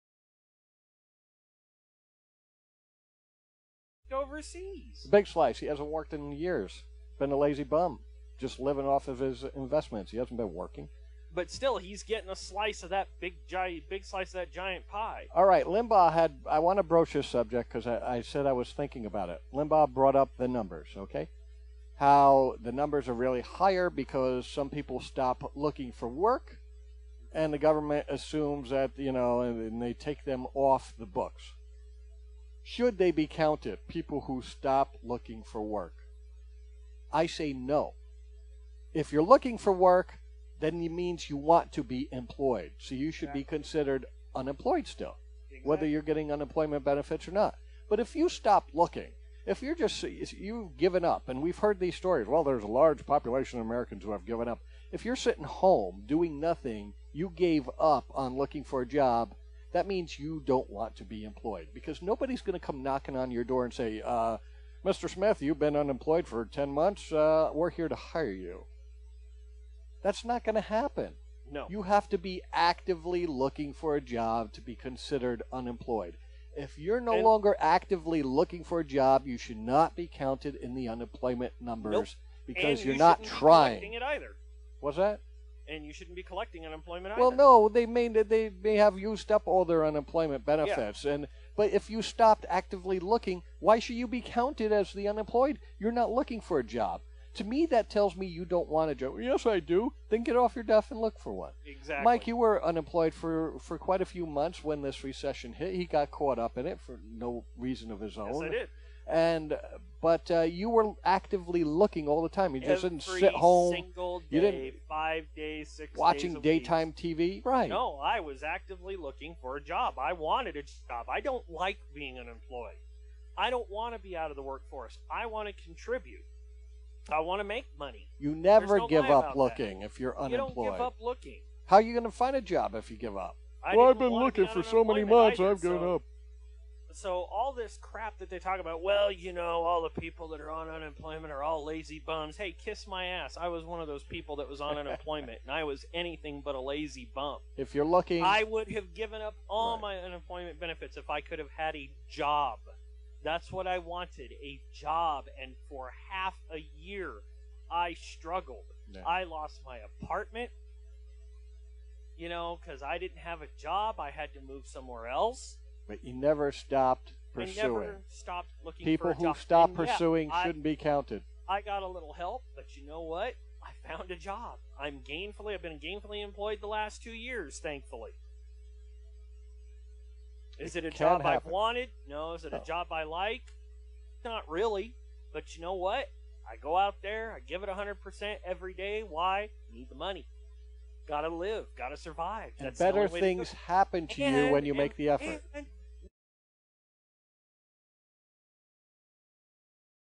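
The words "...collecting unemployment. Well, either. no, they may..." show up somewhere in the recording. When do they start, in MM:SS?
01:26.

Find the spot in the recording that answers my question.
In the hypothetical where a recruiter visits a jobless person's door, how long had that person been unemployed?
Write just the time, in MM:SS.
01:06.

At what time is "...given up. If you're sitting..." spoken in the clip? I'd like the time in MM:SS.
00:54.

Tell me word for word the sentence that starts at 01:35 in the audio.
You're not looking for a job.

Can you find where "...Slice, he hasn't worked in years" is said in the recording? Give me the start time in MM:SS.
00:05.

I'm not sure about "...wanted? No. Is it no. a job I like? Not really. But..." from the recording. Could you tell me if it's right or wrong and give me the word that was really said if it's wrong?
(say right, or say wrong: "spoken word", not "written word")
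right.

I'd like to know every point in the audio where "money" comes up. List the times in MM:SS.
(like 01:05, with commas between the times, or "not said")
02:07, 03:09.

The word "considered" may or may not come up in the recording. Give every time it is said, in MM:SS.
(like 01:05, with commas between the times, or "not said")
00:43, 01:14.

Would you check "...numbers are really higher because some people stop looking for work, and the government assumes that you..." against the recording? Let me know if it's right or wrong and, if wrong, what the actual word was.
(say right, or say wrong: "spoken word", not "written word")
right.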